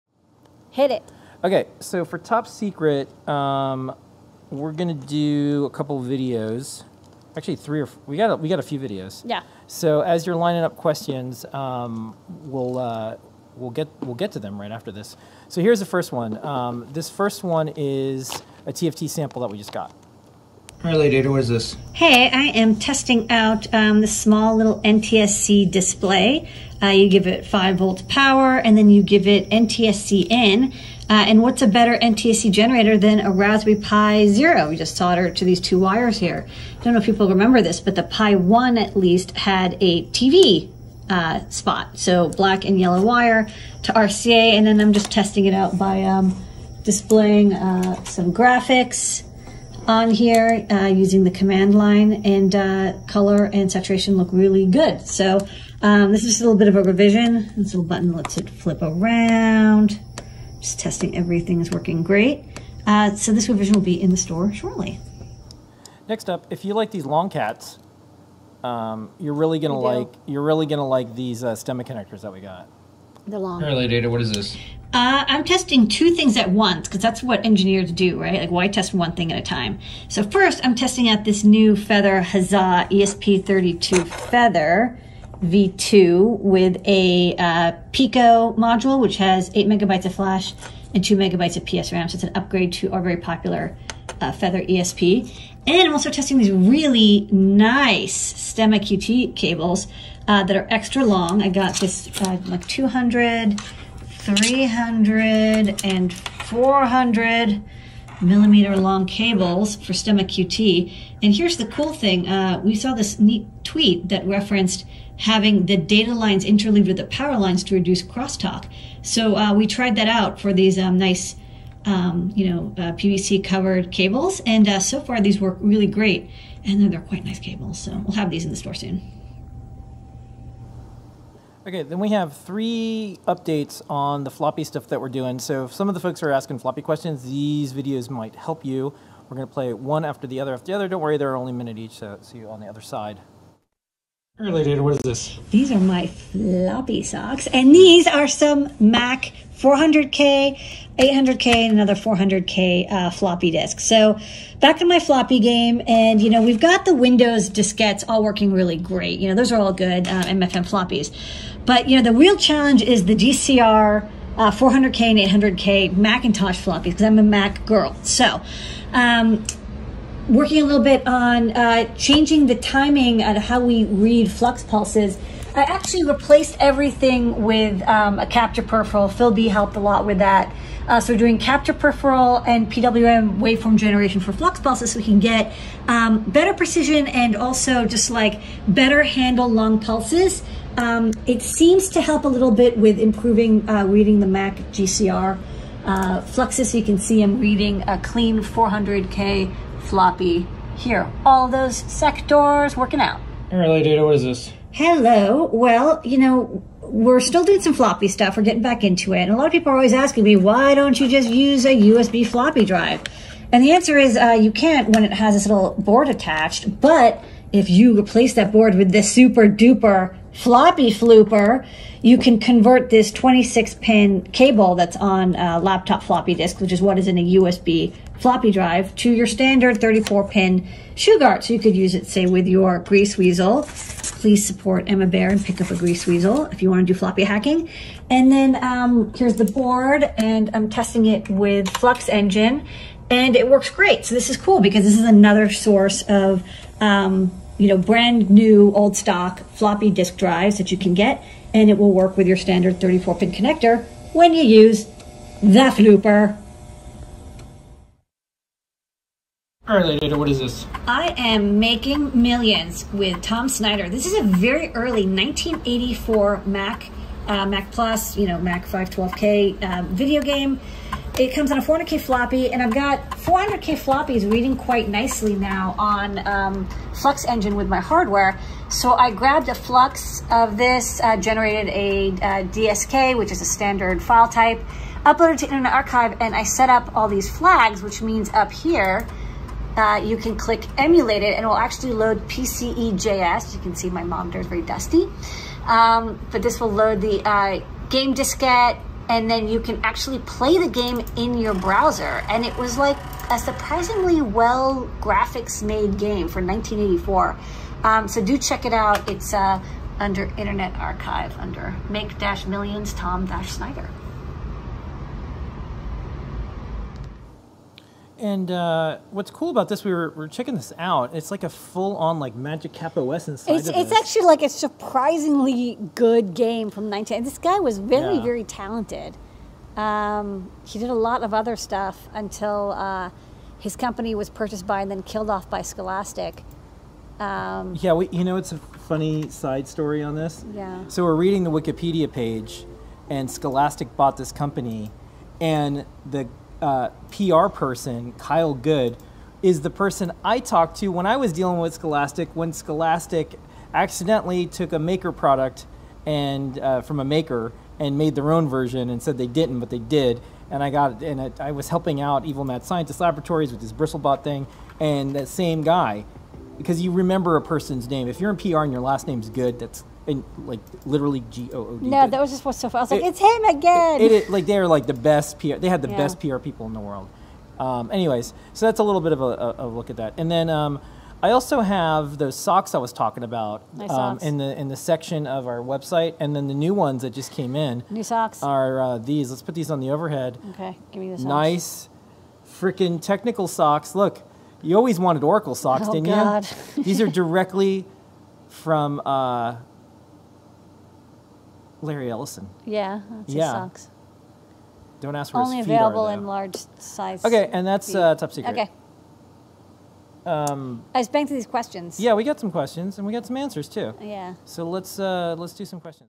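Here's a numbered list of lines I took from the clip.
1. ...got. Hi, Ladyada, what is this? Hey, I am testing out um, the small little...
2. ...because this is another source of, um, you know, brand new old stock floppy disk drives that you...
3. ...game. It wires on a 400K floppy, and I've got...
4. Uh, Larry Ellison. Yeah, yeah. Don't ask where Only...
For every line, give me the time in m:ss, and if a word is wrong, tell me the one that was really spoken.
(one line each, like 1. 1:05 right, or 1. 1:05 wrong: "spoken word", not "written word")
1. 0:19 right
2. 4:04 right
3. 4:30 wrong: "comes", not "wires"
4. 6:39 right.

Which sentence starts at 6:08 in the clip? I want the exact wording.
If you're in PR and your last name's Good, that's and like literally G O O D.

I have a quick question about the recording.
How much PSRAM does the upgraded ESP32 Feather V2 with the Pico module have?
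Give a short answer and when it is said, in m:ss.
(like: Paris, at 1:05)
2 megabytes, at 1:31.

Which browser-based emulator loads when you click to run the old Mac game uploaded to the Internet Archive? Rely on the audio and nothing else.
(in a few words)
PCE.js.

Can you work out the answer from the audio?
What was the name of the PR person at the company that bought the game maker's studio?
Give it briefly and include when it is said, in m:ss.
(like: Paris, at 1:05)
Kyle Good, at 5:48.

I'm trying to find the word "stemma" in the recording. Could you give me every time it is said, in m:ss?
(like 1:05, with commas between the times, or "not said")
1:11, 1:38, 1:49.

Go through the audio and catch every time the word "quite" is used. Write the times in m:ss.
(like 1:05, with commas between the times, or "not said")
2:07, 4:34.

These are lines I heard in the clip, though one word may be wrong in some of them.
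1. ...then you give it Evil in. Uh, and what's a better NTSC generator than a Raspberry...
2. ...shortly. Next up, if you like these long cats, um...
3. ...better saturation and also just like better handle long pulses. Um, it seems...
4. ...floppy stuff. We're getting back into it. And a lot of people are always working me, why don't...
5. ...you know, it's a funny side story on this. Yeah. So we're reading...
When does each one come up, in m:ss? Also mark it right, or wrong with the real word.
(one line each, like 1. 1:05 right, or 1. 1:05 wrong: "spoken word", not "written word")
1. 0:28 wrong: "NTSC", not "Evil"
2. 1:04 right
3. 3:06 wrong: "precision", not "saturation"
4. 3:27 wrong: "asking", not "working"
5. 5:38 right.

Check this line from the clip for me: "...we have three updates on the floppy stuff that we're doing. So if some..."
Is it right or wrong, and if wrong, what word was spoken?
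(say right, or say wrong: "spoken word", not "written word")
right.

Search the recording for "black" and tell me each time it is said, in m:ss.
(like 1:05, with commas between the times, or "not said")
0:42.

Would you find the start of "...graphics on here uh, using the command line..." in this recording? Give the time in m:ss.
0:48.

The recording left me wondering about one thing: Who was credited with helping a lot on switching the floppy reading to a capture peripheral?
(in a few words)
Phil B.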